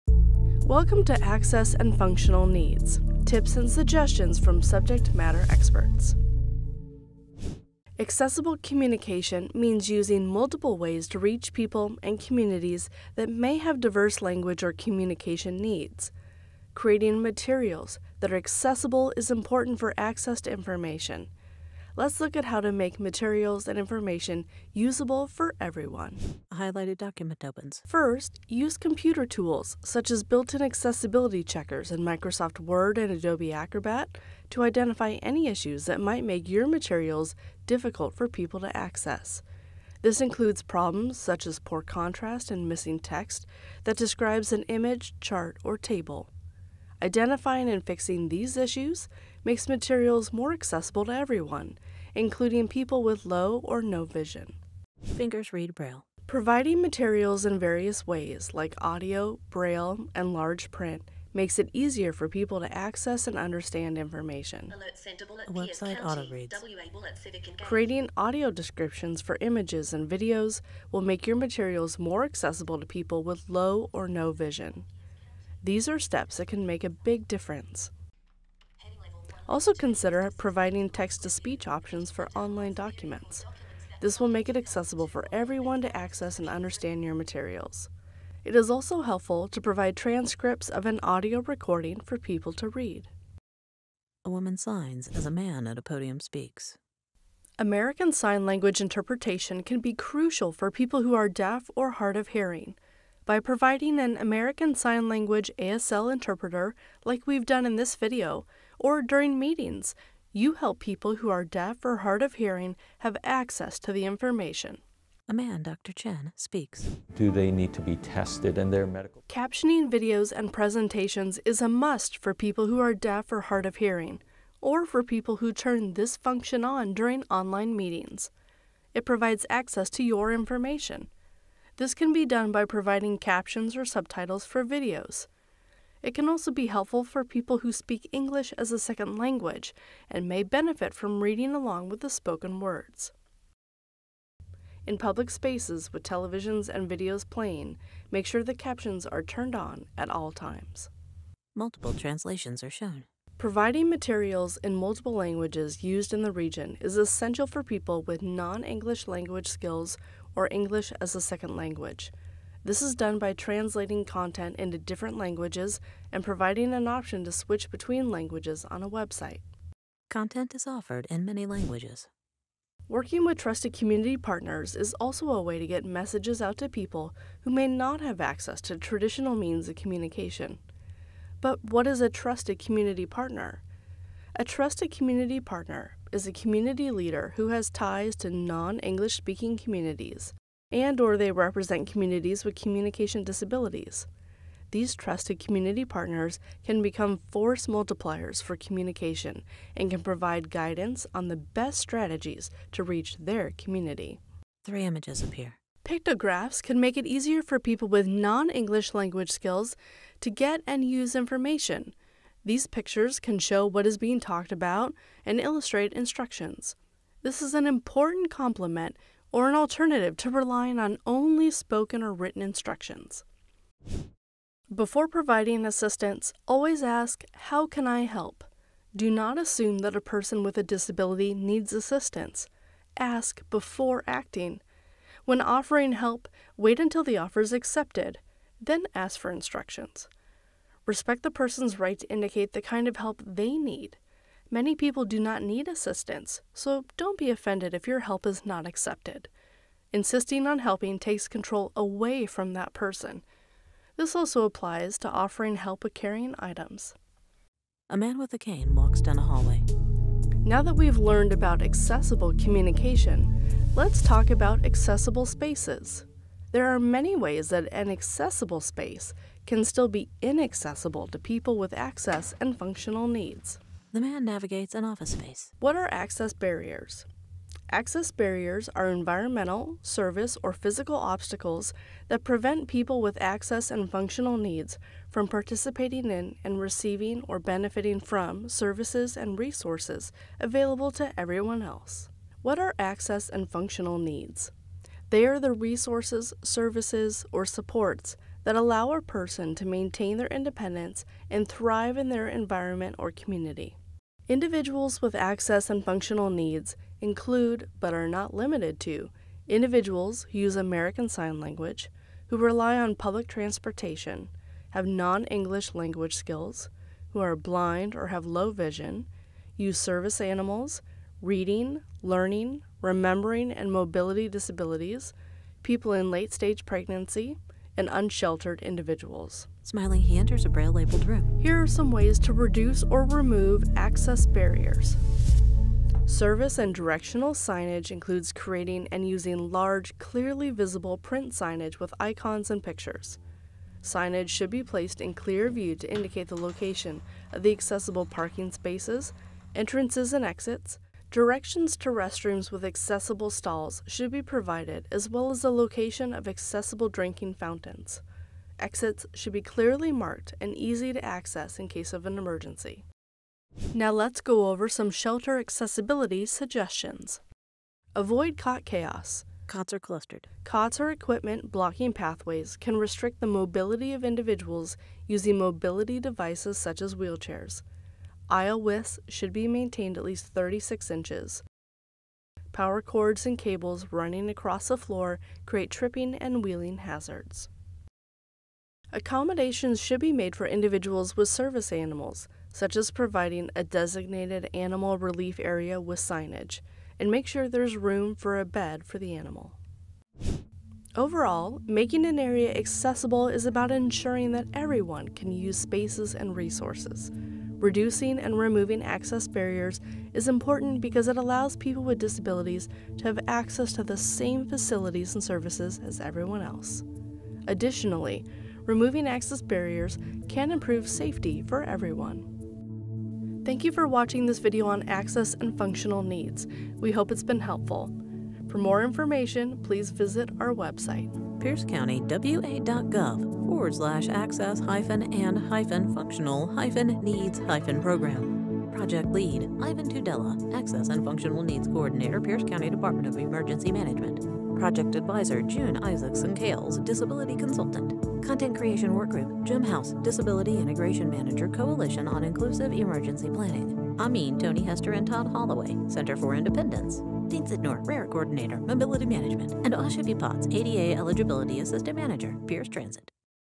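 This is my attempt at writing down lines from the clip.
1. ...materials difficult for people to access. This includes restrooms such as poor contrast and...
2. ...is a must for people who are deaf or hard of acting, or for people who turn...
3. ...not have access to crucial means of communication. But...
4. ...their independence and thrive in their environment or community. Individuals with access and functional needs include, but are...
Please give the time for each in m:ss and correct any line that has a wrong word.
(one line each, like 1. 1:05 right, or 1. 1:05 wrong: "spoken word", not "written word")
1. 0:36 wrong: "problems", not "restrooms"
2. 2:01 wrong: "hearing", not "acting"
3. 2:57 wrong: "traditional", not "crucial"
4. 5:00 right.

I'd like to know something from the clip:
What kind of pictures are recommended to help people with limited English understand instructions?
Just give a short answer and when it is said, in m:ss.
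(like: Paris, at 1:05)
Pictographs, at 3:25.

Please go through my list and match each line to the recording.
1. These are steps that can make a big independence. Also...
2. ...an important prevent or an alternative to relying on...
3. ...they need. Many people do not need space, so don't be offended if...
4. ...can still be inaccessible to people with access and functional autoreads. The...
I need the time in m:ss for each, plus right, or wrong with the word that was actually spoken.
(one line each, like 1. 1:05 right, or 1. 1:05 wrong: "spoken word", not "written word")
1. 1:15 wrong: "difference", not "independence"
2. 3:37 wrong: "complement", not "prevent"
3. 4:03 wrong: "assistance", not "space"
4. 4:29 wrong: "needs", not "autoreads".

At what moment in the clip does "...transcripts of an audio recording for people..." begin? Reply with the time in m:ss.
1:29.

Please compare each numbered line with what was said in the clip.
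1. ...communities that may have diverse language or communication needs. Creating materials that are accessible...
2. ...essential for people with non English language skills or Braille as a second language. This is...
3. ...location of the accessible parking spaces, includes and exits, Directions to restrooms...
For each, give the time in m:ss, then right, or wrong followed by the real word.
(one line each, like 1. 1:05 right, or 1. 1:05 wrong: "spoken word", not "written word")
1. 0:12 right
2. 2:36 wrong: "English", not "Braille"
3. 5:46 wrong: "entrances", not "includes".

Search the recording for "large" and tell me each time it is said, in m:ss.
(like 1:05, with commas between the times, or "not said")
1:00, 5:39.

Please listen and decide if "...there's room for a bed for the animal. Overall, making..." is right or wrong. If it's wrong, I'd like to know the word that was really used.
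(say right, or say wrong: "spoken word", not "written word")
right.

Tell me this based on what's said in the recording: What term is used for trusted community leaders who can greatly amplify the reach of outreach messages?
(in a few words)
force multipliers.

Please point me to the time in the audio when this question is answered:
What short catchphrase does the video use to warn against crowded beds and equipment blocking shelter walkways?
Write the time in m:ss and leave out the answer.
6:07.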